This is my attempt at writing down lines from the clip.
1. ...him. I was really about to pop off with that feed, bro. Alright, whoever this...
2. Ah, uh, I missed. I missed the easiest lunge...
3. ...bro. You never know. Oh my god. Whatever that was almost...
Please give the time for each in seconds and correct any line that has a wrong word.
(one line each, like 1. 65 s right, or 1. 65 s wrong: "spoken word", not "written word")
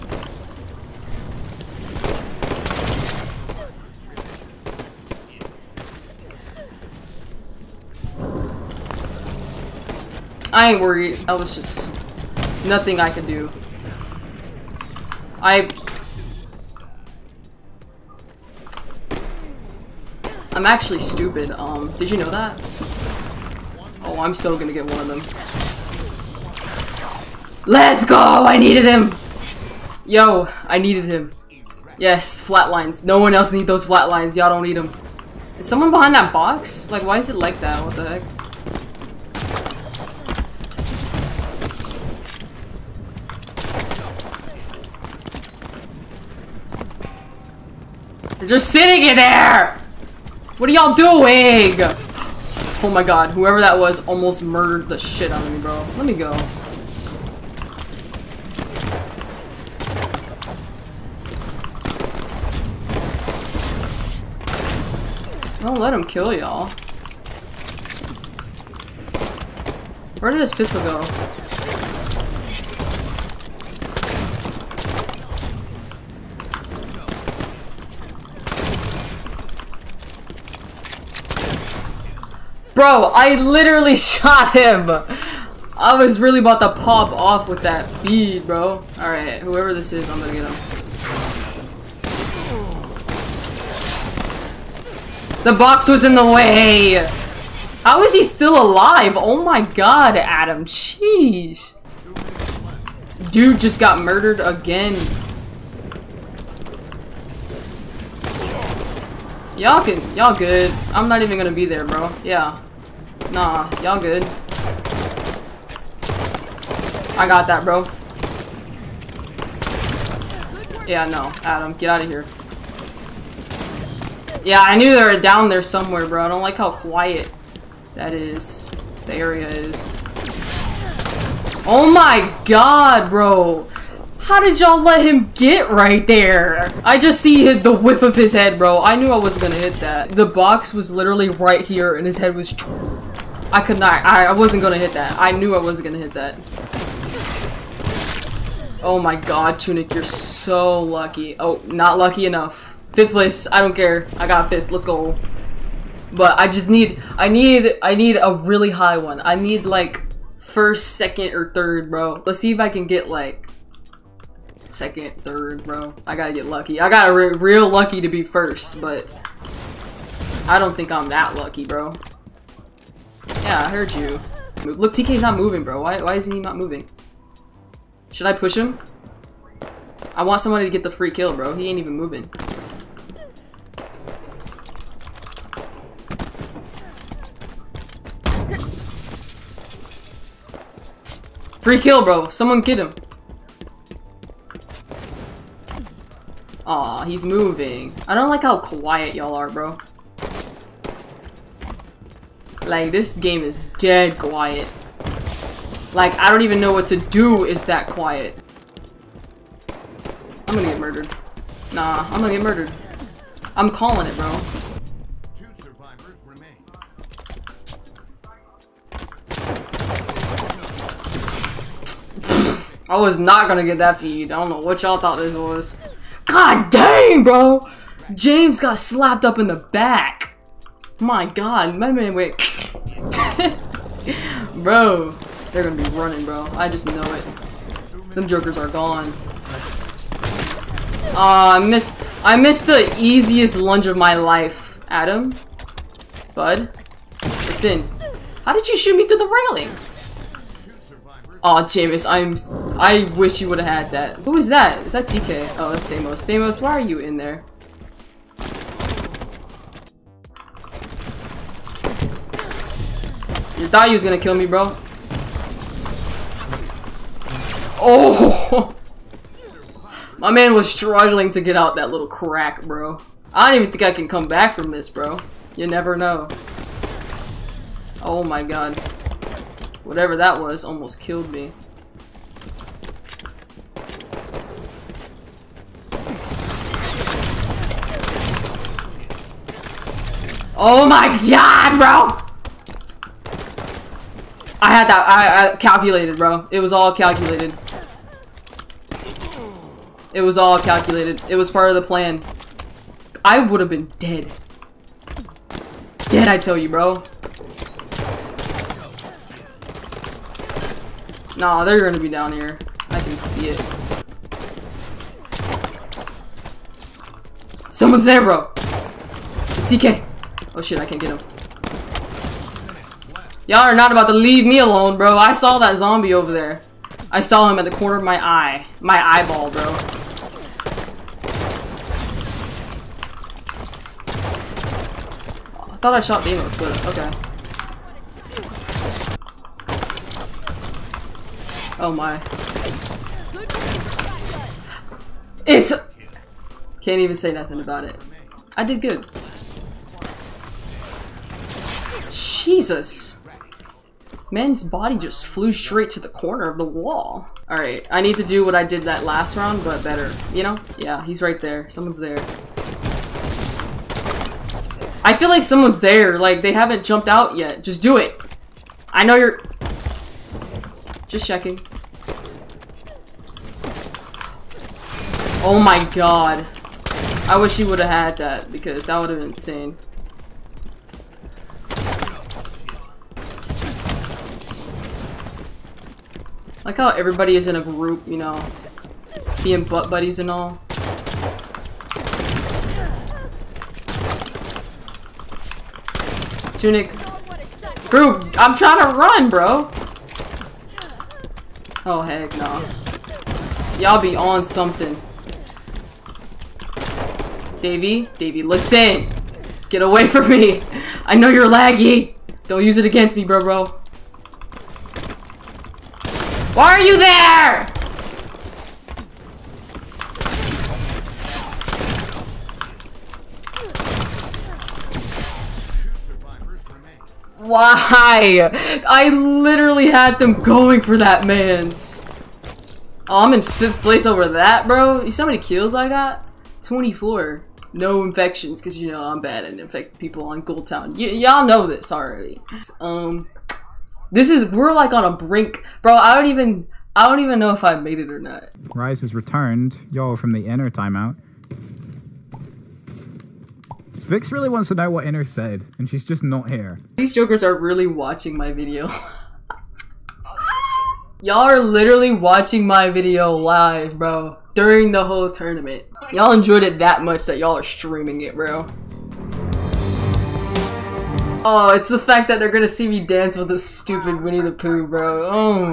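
1. 84 s right
2. 241 s right
3. 274 s right.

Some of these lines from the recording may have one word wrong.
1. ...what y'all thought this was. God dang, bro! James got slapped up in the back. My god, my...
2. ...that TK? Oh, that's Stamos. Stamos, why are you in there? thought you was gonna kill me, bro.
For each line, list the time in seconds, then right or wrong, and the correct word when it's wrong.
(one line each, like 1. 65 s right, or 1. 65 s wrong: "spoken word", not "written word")
1. 224 s right
2. 254 s right.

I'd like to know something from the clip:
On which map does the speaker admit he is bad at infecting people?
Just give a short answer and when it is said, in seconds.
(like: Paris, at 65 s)
Gold Town, at 440 s.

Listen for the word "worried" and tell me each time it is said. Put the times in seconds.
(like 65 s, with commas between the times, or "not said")
10 s.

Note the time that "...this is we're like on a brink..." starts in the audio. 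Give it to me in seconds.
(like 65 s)
444 s.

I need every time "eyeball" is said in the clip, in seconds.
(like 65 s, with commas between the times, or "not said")
328 s.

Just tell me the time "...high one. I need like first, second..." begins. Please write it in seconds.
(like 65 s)
158 s.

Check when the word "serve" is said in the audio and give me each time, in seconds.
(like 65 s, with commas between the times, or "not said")
not said.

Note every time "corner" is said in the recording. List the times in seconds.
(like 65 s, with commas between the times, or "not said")
327 s, 356 s.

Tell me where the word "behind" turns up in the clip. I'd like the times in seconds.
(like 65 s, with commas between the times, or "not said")
35 s.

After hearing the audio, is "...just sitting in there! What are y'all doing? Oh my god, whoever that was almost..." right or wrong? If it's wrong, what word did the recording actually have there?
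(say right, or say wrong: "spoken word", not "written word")
right.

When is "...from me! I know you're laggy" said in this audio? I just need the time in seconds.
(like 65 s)
410 s.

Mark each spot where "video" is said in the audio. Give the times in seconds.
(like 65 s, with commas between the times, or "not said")
458 s, 462 s.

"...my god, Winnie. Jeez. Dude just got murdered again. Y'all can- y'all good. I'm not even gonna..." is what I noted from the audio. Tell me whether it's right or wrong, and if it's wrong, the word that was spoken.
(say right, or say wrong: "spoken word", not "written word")
wrong: "Adam", not "Winnie".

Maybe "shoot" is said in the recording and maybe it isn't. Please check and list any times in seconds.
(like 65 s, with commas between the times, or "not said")
248 s.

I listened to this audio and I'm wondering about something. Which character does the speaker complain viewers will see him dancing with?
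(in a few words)
Winnie the Pooh.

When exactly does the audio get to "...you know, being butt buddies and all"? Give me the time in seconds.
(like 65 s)
388 s.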